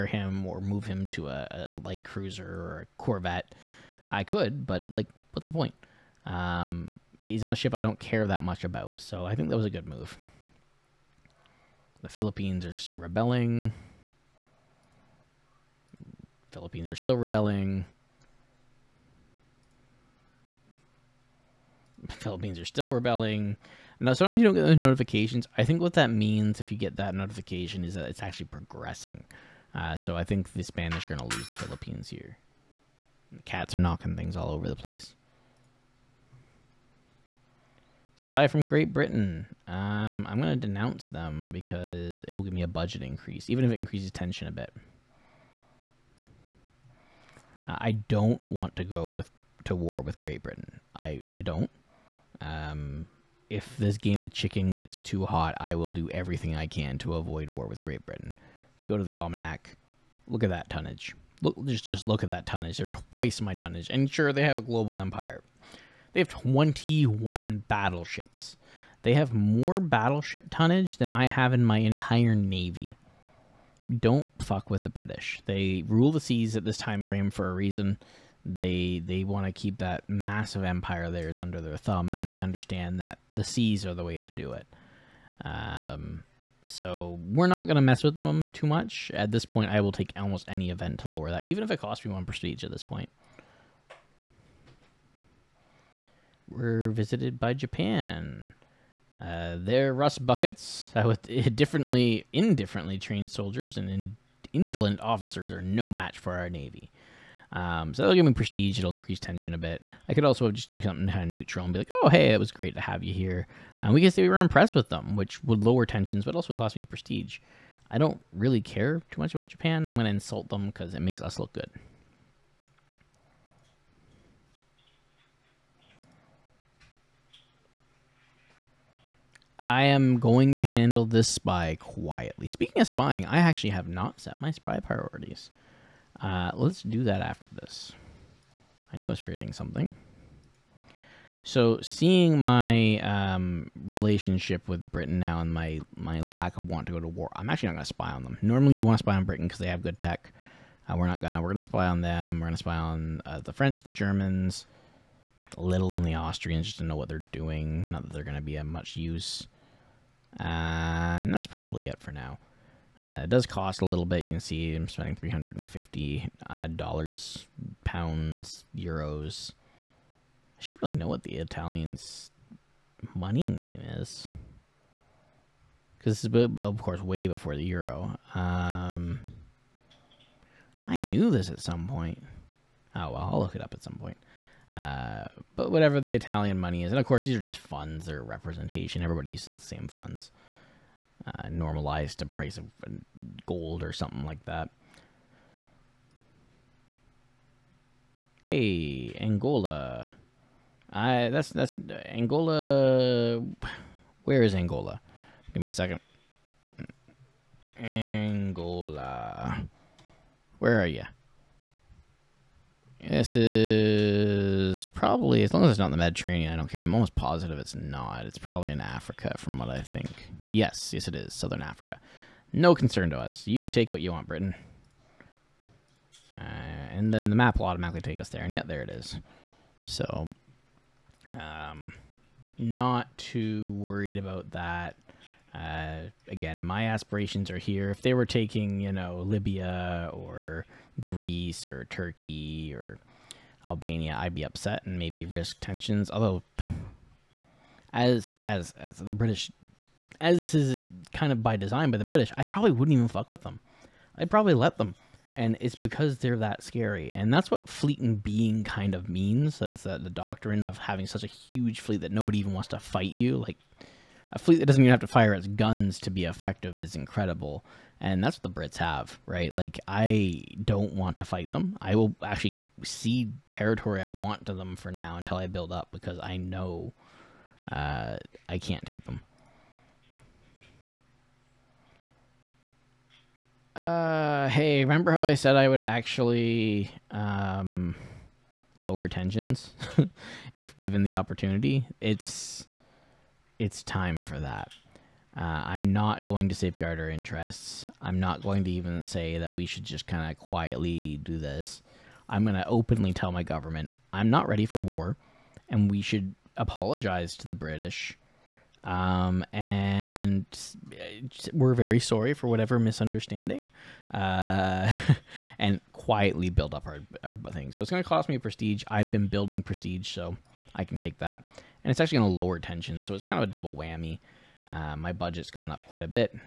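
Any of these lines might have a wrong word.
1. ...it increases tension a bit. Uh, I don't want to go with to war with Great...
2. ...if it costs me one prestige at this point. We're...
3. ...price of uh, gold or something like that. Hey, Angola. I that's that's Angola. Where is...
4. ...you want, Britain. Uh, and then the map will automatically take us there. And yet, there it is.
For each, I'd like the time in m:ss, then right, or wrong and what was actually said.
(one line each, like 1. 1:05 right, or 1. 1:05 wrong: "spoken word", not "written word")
1. 0:43 right
2. 1:31 right
3. 3:12 right
4. 3:44 right.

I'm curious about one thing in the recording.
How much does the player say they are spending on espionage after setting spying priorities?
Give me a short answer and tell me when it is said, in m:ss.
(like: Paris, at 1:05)
350, at 2:45.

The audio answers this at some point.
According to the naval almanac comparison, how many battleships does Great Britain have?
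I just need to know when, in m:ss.
1:06.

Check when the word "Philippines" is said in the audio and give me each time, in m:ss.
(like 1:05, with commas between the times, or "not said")
0:12, 0:16, 0:22, 0:31.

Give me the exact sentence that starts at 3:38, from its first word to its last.
It's probably in Africa, from what I think.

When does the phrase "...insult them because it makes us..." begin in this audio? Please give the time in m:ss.
2:00.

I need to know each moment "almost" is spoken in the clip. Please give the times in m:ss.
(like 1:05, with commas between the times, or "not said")
1:30, 3:36.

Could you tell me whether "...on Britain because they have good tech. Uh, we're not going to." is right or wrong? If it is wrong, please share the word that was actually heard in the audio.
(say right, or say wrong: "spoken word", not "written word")
right.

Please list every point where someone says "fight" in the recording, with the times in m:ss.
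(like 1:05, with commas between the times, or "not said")
4:22, 4:31.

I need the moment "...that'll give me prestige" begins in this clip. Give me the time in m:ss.
1:48.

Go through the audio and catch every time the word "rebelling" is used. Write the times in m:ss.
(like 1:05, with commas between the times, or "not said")
0:12, 0:17, 0:22.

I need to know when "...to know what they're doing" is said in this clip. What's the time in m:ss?
2:36.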